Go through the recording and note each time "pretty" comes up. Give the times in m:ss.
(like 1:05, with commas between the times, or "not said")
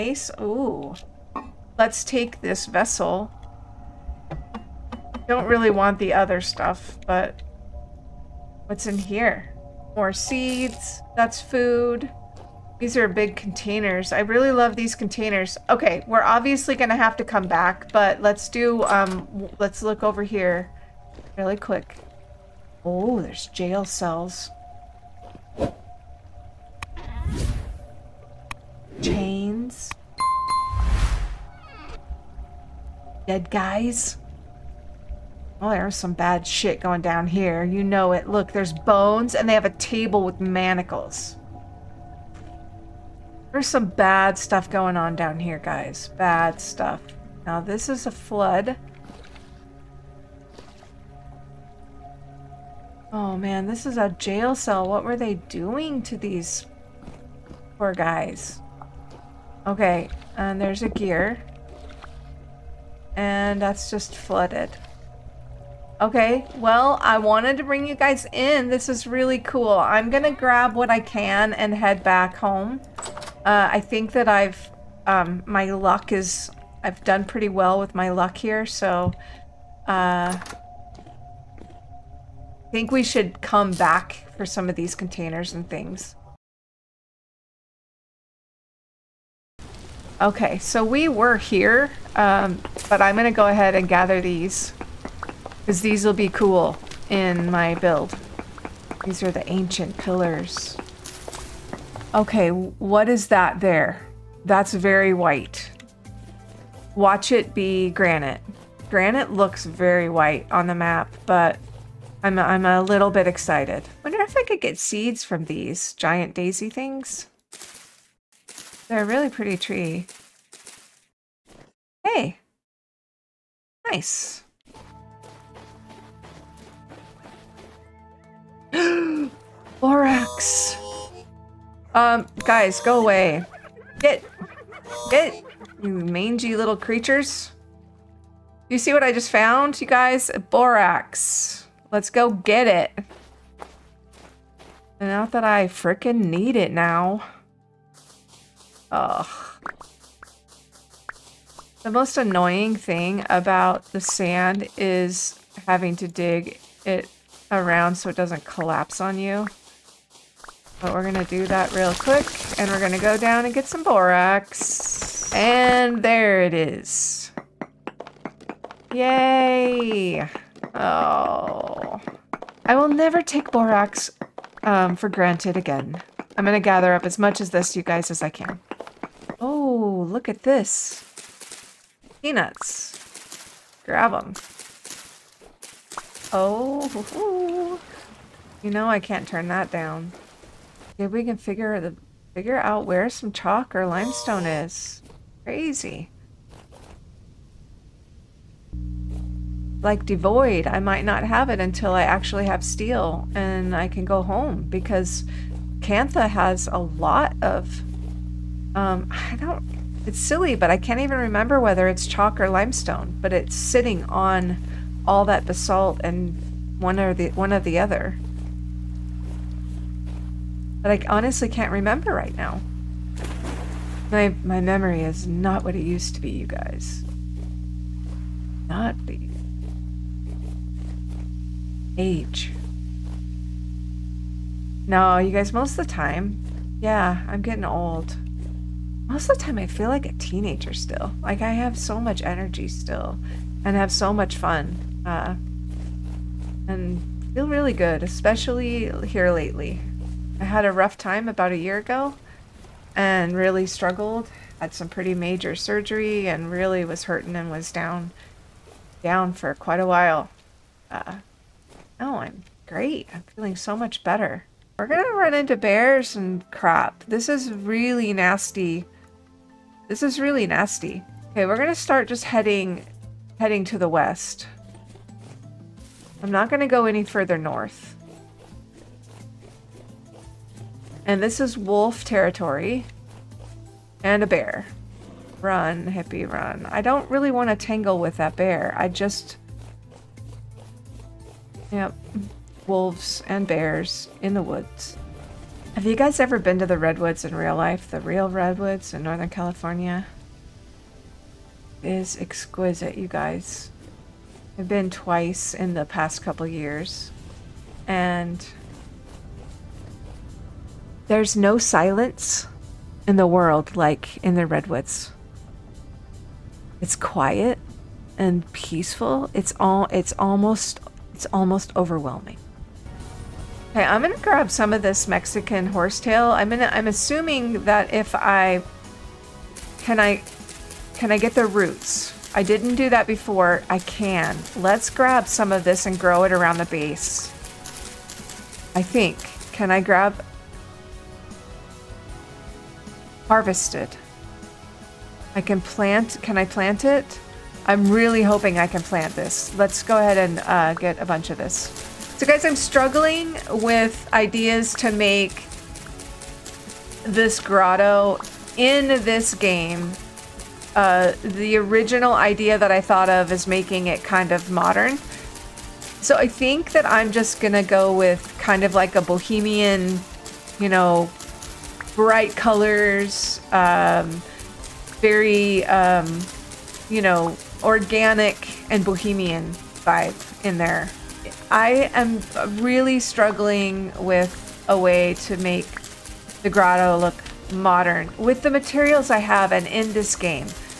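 1:17, 1:59, 4:14.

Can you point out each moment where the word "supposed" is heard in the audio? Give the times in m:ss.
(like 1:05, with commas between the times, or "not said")
not said.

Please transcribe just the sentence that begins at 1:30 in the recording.
Okay, so we were here, um, but I'm going to go ahead and gather these.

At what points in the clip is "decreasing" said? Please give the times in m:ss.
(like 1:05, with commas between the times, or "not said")
not said.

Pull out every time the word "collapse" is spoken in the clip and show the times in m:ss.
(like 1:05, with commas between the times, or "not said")
2:38.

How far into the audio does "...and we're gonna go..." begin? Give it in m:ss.
2:42.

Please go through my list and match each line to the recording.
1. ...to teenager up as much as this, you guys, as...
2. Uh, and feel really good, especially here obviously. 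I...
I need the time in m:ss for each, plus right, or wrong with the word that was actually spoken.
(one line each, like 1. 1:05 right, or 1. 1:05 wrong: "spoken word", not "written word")
1. 2:56 wrong: "gather", not "teenager"
2. 4:05 wrong: "lately", not "obviously".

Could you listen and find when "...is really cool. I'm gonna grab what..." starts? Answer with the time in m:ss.
1:08.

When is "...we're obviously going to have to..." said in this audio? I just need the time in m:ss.
0:16.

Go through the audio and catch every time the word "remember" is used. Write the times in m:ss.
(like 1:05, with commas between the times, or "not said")
3:31, 3:41.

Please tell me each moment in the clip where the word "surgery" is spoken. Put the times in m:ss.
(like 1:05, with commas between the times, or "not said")
4:15.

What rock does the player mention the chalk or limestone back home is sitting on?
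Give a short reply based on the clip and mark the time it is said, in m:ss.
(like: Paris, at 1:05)
basalt, at 3:35.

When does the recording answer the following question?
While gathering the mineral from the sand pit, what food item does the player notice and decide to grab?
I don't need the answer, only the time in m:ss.
3:02.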